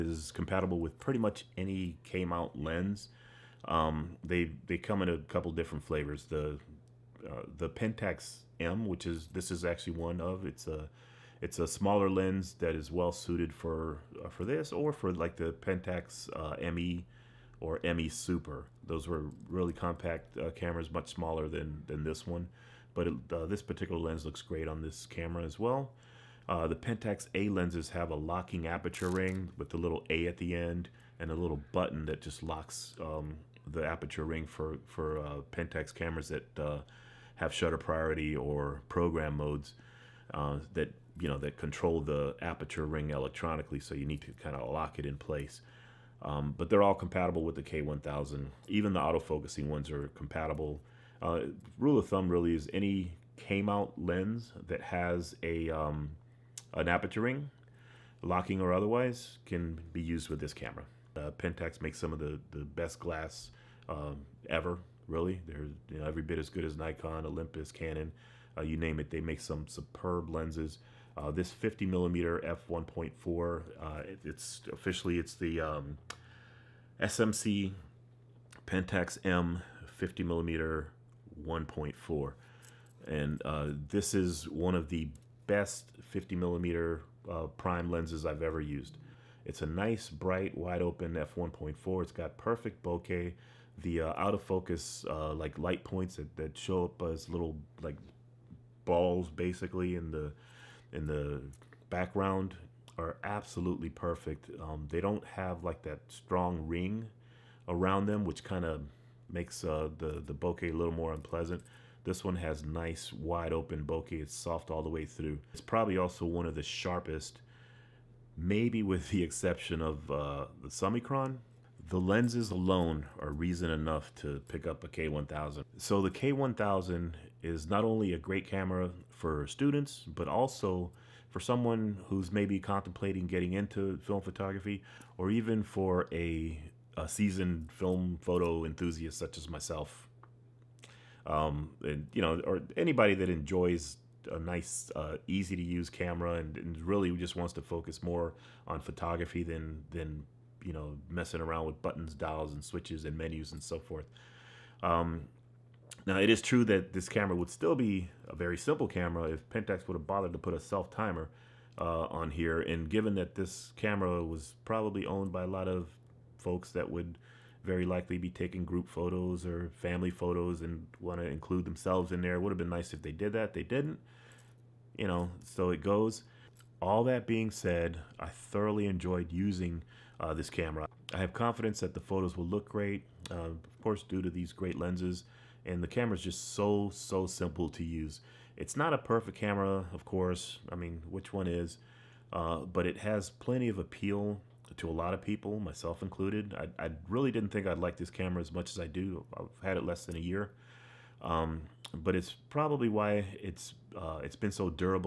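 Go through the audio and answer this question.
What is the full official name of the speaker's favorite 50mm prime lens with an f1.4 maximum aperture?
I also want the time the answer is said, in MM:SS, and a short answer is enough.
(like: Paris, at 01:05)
SMC Pentax M 50mm 1.4, at 01:17.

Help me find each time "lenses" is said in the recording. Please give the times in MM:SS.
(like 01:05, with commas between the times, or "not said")
00:27, 01:10, 01:27, 02:01, 03:04.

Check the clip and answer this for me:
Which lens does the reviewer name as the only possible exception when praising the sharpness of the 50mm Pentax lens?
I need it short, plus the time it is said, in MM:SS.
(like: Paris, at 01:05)
Summicron, at 02:00.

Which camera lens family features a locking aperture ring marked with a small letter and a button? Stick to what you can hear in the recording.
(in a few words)
Pentax A.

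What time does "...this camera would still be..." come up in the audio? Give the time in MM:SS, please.
02:36.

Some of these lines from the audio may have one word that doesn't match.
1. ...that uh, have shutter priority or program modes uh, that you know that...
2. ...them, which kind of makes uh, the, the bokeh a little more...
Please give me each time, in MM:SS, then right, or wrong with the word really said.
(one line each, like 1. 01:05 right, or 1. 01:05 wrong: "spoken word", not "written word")
1. 00:36 right
2. 01:48 right.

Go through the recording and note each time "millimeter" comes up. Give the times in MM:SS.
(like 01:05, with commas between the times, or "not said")
01:11, 01:20, 01:26.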